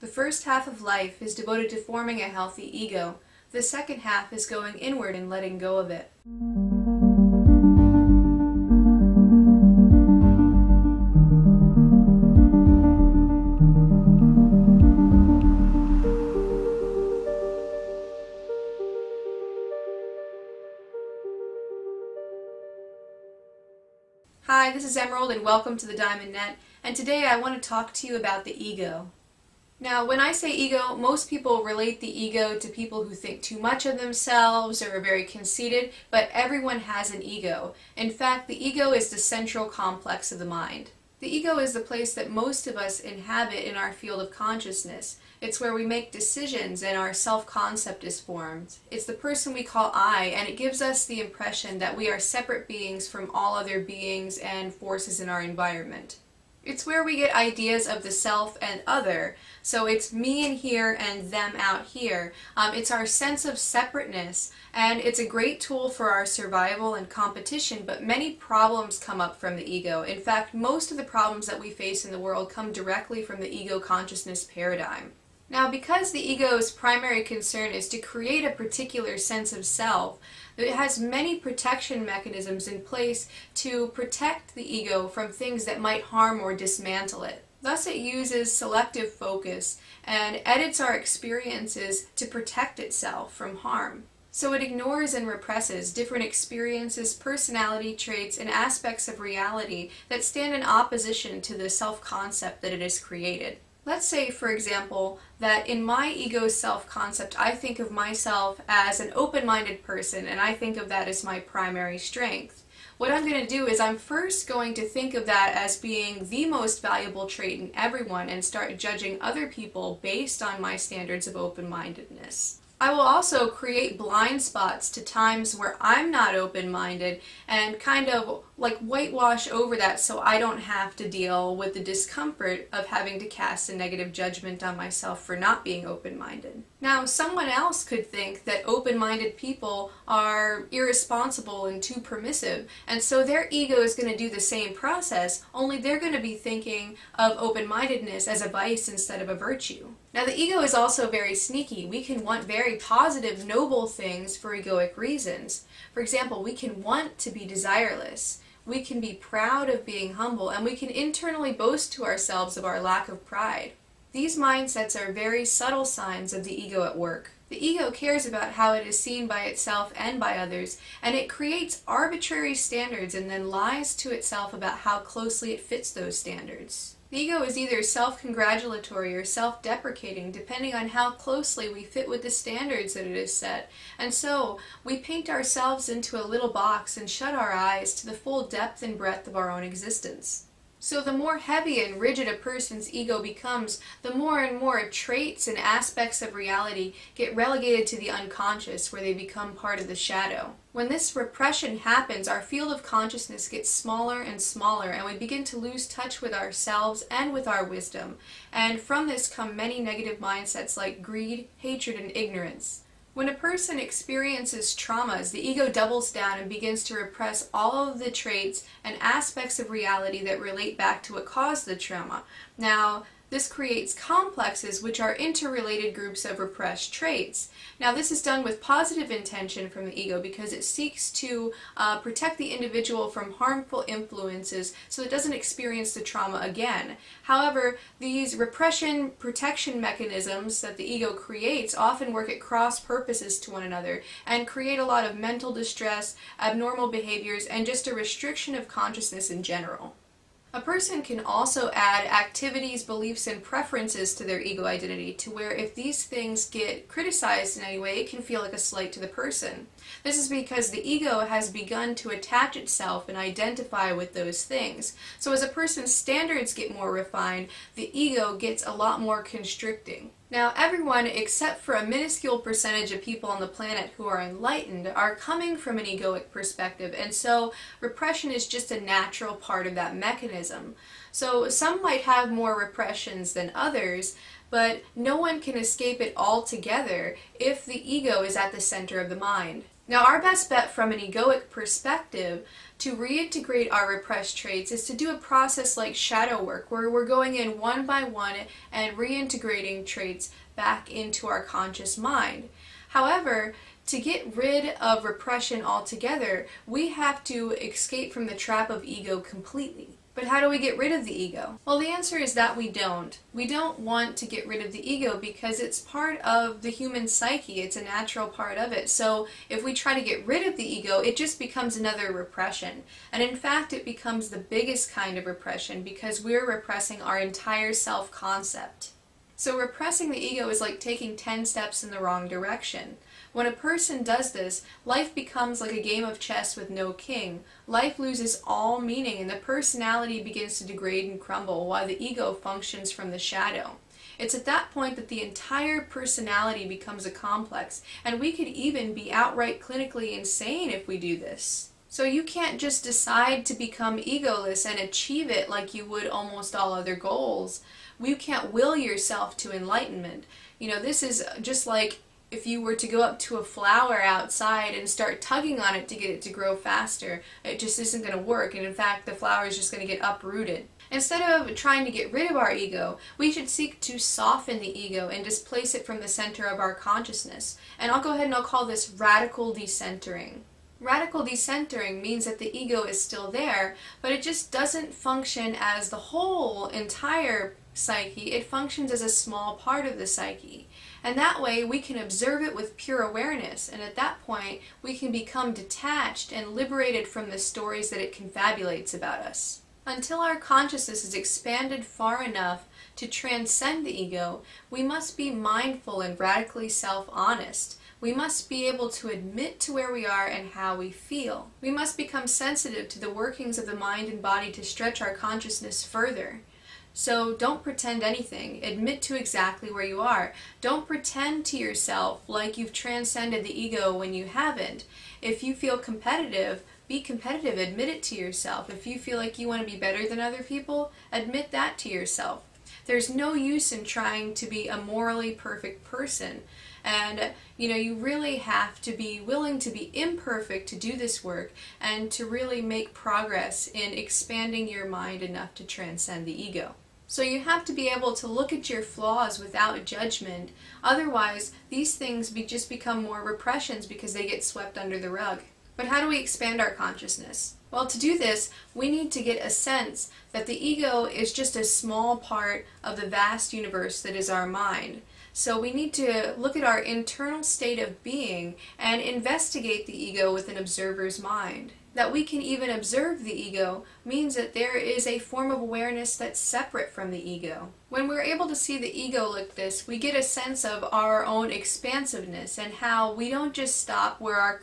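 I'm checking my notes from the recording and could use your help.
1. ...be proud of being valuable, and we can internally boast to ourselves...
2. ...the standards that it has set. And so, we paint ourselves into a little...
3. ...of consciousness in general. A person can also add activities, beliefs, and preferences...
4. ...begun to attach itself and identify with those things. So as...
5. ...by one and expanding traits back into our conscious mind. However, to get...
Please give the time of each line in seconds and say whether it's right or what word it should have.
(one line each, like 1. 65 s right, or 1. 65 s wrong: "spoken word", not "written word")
1. 159 s wrong: "humble", not "valuable"
2. 182 s right
3. 248 s right
4. 261 s right
5. 297 s wrong: "reintegrating", not "expanding".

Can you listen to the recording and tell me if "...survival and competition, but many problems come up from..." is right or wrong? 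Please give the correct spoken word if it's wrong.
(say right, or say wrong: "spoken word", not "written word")
right.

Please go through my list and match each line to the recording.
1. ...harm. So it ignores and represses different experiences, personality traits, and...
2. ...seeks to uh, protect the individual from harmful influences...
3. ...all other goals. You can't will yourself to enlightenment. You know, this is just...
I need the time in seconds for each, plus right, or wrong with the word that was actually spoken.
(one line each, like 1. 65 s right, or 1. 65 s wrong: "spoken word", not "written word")
1. 93 s right
2. 230 s right
3. 356 s right.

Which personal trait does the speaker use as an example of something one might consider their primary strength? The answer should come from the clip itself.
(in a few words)
open minded.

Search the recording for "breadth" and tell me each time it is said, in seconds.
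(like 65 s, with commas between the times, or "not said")
188 s.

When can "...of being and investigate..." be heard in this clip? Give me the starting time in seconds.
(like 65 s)
467 s.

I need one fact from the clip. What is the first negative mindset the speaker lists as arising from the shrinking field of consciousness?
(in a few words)
greed.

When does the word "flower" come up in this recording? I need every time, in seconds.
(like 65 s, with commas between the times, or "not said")
363 s, 369 s.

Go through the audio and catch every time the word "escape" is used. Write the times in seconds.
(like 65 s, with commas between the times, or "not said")
285 s, 307 s.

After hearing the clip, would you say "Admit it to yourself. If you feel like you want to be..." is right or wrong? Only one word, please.
right.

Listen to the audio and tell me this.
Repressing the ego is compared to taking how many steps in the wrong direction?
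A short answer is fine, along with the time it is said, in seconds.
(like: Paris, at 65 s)
10, at 331 s.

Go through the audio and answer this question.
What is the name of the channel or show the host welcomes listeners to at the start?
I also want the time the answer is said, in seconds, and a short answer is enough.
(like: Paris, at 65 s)
Diamond Net, at 25 s.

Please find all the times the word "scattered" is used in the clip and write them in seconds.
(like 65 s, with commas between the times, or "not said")
not said.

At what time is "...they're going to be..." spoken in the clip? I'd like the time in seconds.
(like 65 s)
145 s.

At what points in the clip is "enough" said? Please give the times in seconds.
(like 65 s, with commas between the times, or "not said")
402 s, 445 s.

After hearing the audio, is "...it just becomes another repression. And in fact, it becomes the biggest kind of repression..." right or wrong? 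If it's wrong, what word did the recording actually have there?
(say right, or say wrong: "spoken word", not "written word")
right.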